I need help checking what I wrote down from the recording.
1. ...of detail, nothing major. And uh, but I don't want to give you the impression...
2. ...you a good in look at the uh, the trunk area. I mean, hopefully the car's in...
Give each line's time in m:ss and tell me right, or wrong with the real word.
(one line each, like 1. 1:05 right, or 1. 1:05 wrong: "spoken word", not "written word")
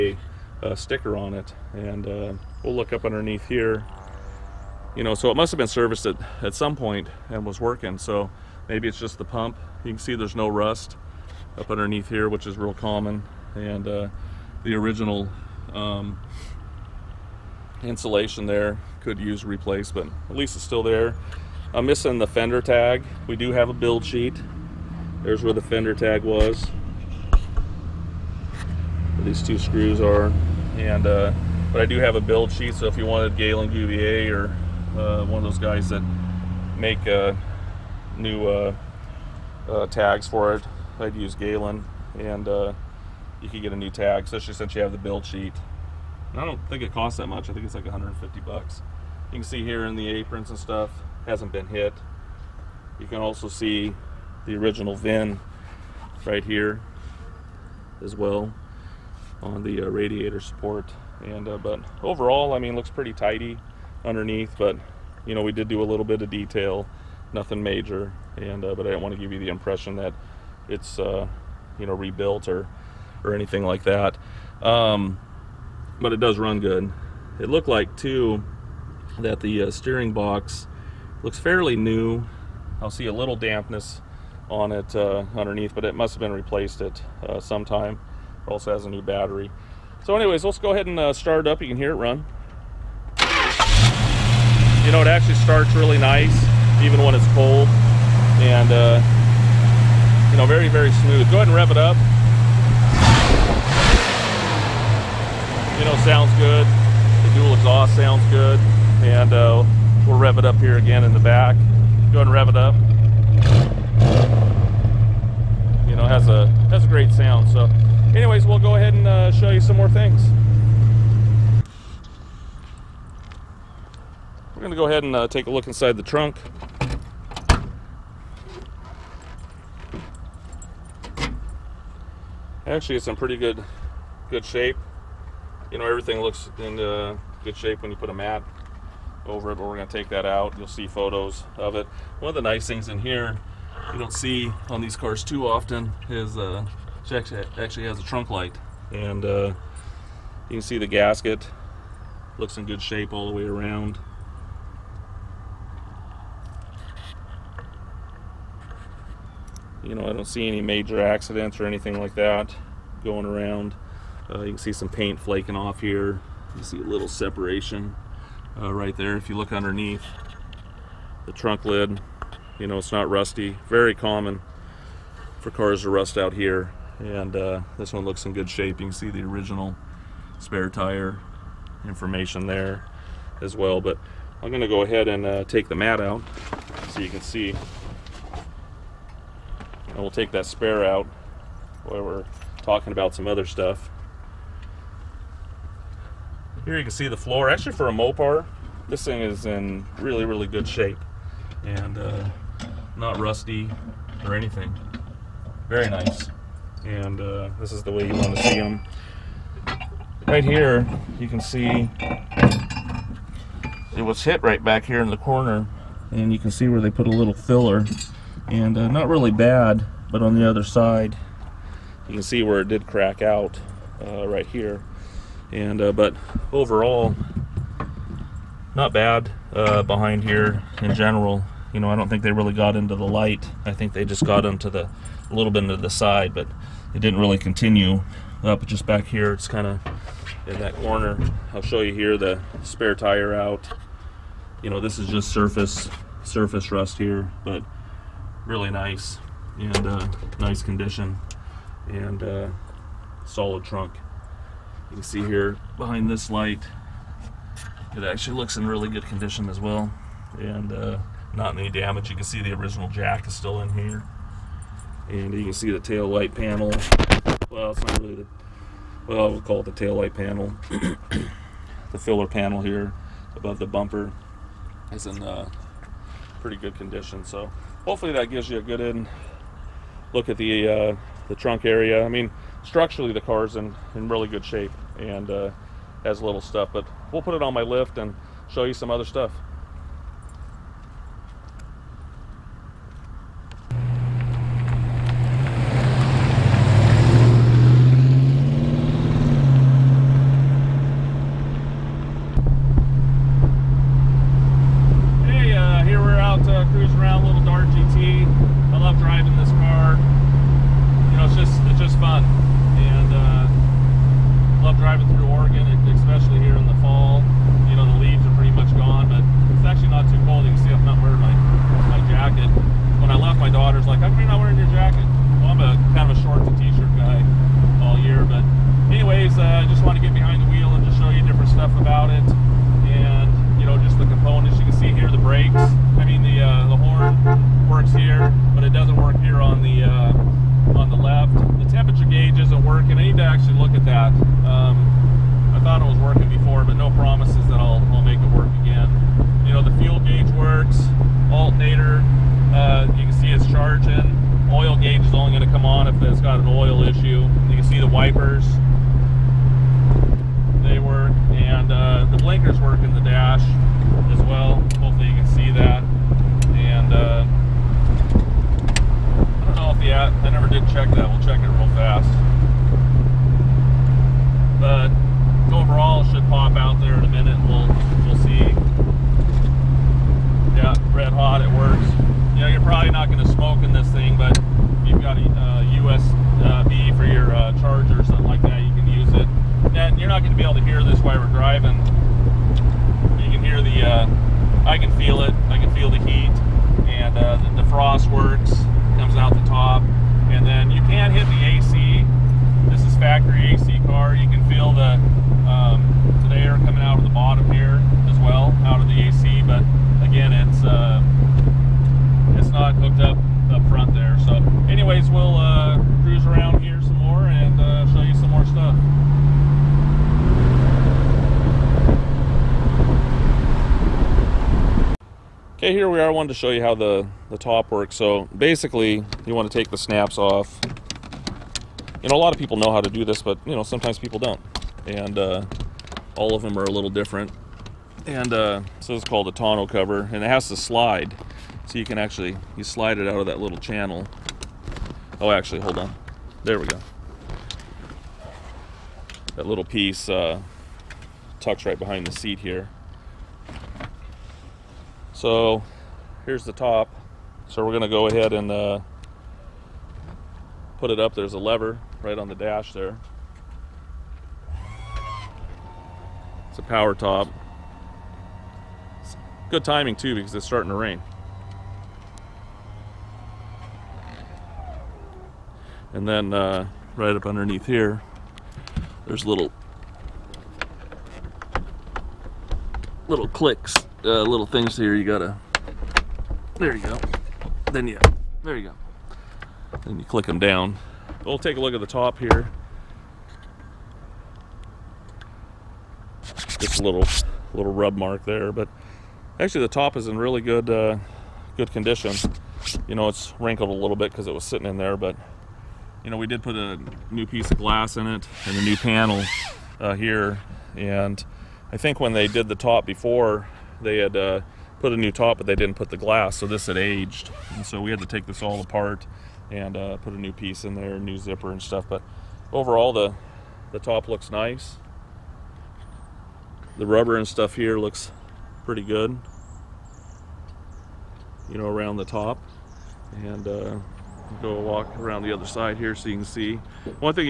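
1. 1:06 right
2. 4:38 wrong: "structurally", not "hopefully".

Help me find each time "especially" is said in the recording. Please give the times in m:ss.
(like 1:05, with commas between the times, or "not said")
0:44.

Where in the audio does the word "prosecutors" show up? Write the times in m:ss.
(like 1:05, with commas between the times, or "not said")
not said.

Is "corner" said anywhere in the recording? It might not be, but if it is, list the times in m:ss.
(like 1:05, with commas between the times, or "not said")
3:35, 4:00.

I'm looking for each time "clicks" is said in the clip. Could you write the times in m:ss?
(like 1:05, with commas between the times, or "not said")
8:03, 8:10.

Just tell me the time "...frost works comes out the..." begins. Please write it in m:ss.
6:37.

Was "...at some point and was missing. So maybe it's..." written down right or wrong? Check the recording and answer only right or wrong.
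wrong.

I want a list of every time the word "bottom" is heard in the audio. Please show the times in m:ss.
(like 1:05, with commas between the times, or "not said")
6:47.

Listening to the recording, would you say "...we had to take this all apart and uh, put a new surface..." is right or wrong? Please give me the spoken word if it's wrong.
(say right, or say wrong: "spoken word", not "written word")
wrong: "piece", not "surface".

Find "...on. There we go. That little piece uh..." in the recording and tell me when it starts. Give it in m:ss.
7:25.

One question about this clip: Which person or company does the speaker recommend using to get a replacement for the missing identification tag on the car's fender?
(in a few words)
Galen Govier.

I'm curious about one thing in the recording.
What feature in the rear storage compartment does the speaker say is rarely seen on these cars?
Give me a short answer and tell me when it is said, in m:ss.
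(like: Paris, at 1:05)
trunk light, at 2:28.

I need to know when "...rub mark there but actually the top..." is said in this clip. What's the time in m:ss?
8:17.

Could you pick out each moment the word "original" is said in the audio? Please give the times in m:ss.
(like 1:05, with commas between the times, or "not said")
0:14, 0:54, 2:59, 4:22.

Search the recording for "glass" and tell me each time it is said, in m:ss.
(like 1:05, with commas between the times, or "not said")
8:27, 8:35.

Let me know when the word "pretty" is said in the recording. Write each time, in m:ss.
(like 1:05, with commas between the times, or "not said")
1:02, 2:13, 4:36, 8:48.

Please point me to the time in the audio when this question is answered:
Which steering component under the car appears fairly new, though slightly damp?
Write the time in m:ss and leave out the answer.
1:19.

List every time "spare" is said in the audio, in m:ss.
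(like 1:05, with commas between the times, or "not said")
3:00, 3:10, 4:02.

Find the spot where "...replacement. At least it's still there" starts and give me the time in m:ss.
0:19.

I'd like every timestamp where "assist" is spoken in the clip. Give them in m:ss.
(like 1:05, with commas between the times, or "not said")
not said.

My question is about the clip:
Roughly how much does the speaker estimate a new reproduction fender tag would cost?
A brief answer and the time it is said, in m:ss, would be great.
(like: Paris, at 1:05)
$150, at 0:47.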